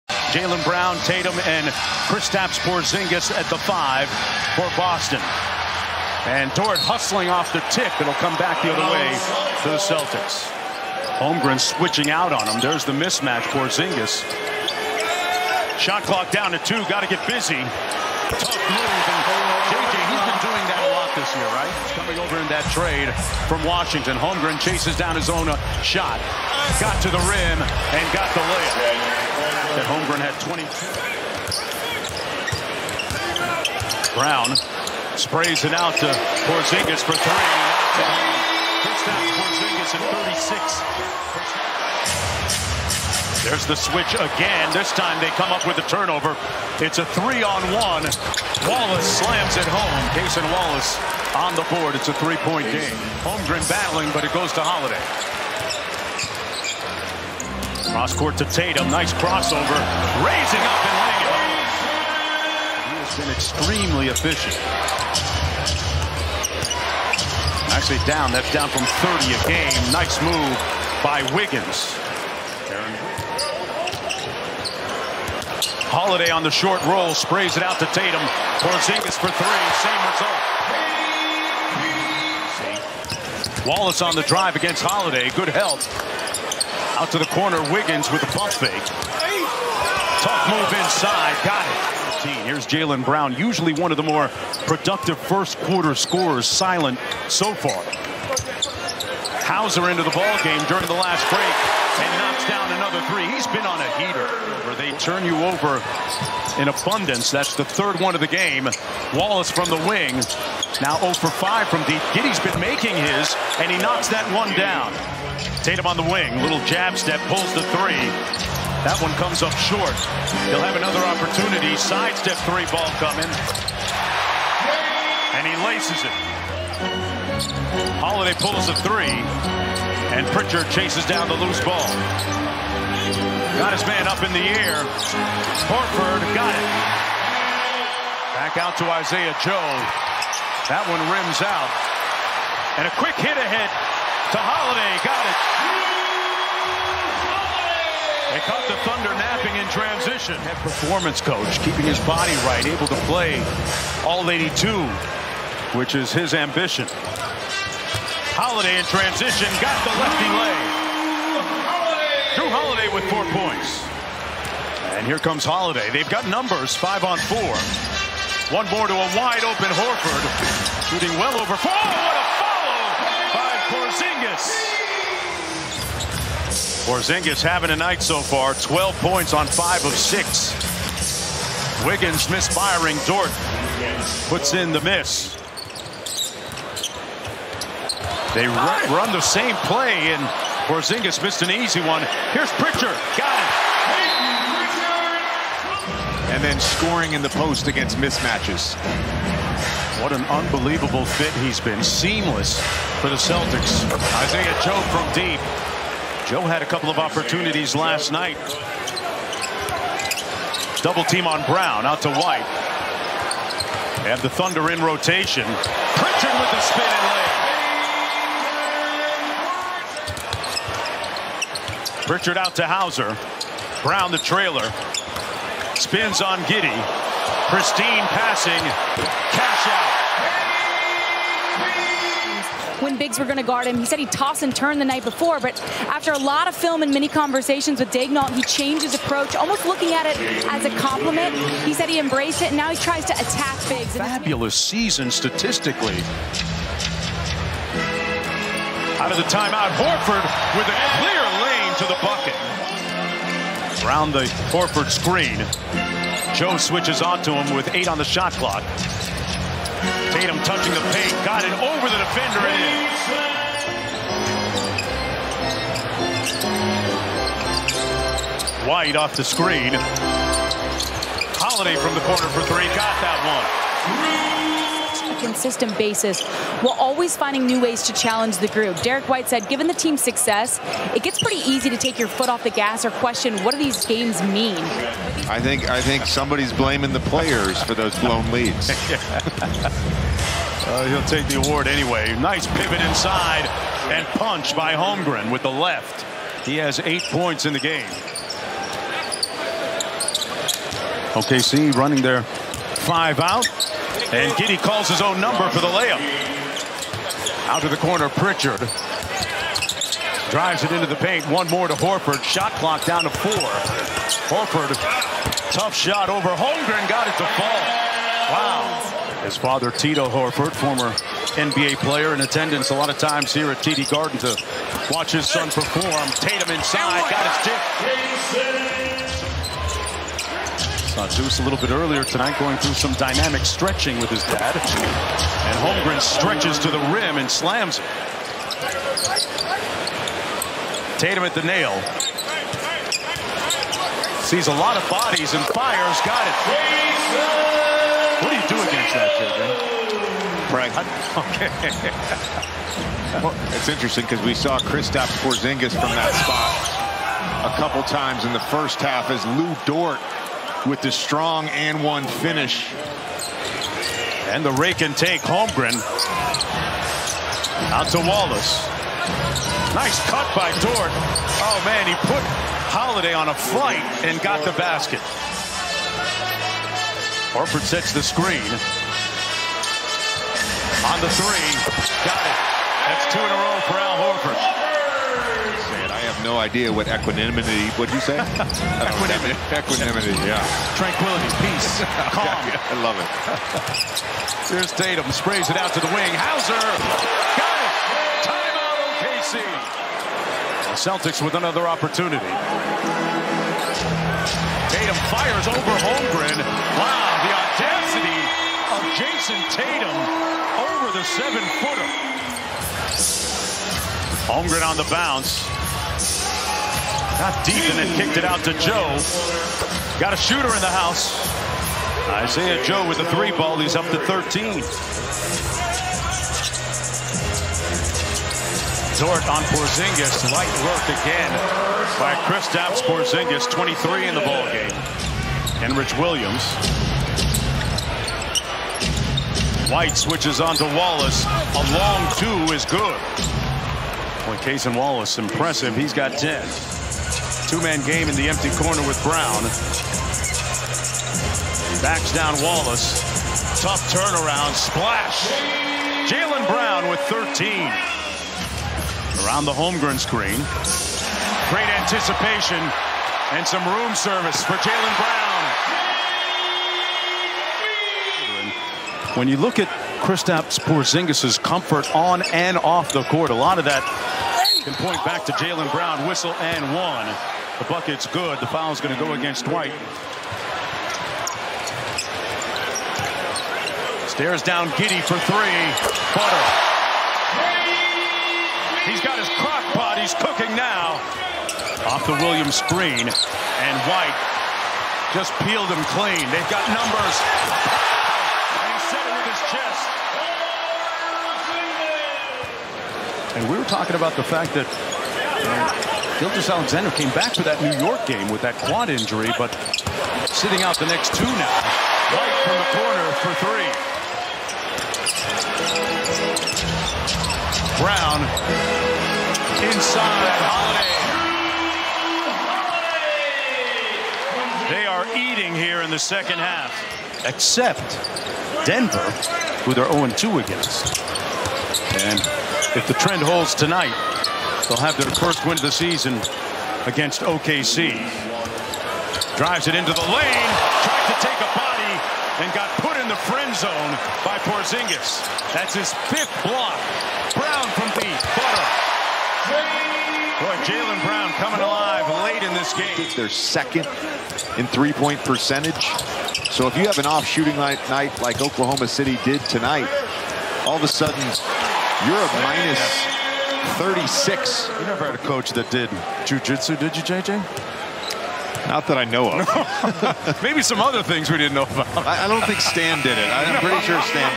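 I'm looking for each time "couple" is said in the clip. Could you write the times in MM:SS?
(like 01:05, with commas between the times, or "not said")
03:26, 05:57.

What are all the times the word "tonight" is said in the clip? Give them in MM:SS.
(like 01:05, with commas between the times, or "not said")
05:32, 08:53, 09:19.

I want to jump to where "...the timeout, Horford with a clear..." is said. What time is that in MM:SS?
04:09.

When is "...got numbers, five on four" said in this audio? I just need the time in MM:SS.
02:46.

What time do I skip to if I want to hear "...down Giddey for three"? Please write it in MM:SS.
08:04.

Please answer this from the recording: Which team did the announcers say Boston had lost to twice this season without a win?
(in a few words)
Denver.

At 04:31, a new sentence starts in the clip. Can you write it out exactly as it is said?
Holiday from the corner for three, got that one consistent basis while always finding new ways to challenge the group.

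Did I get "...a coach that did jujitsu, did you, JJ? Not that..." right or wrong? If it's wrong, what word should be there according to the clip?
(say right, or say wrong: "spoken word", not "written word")
right.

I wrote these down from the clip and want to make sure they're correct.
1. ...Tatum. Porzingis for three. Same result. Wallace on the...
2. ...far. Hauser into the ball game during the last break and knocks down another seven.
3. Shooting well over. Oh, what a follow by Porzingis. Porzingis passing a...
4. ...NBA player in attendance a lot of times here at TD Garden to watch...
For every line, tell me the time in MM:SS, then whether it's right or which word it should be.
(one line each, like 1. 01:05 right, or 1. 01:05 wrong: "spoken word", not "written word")
1. 01:17 right
2. 01:37 wrong: "three", not "seven"
3. 02:50 wrong: "having", not "passing"
4. 05:21 right.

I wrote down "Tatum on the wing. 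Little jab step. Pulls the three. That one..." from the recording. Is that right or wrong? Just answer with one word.
right.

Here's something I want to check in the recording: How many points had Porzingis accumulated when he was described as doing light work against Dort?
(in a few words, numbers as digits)
23.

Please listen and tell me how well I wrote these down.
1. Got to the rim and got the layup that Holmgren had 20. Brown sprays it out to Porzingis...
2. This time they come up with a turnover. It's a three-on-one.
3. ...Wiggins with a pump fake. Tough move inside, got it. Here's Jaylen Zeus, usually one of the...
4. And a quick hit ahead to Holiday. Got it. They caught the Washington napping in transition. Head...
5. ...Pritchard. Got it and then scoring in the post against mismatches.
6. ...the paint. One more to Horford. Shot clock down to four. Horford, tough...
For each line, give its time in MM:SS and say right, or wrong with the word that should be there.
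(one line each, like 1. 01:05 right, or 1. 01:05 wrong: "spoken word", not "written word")
1. 00:26 right
2. 00:44 right
3. 01:27 wrong: "Brown", not "Zeus"
4. 02:22 wrong: "Thunder", not "Washington"
5. 03:12 right
6. 05:10 right.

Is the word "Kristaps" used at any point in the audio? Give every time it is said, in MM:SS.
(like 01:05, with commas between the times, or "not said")
00:02, 05:54, 07:12, 07:50.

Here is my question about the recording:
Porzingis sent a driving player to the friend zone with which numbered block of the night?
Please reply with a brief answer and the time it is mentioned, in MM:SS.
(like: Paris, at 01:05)
5, at 09:06.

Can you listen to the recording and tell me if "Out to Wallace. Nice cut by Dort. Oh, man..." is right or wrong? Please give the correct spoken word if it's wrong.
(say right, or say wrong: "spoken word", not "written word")
right.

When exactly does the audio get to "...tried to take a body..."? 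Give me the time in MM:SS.
09:00.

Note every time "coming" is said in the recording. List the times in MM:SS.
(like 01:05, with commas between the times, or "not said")
00:21, 02:03, 09:11.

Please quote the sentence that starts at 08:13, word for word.
And White just peeled him clean.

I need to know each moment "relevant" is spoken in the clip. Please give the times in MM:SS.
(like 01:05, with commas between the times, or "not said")
not said.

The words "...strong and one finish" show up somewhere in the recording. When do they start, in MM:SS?
06:00.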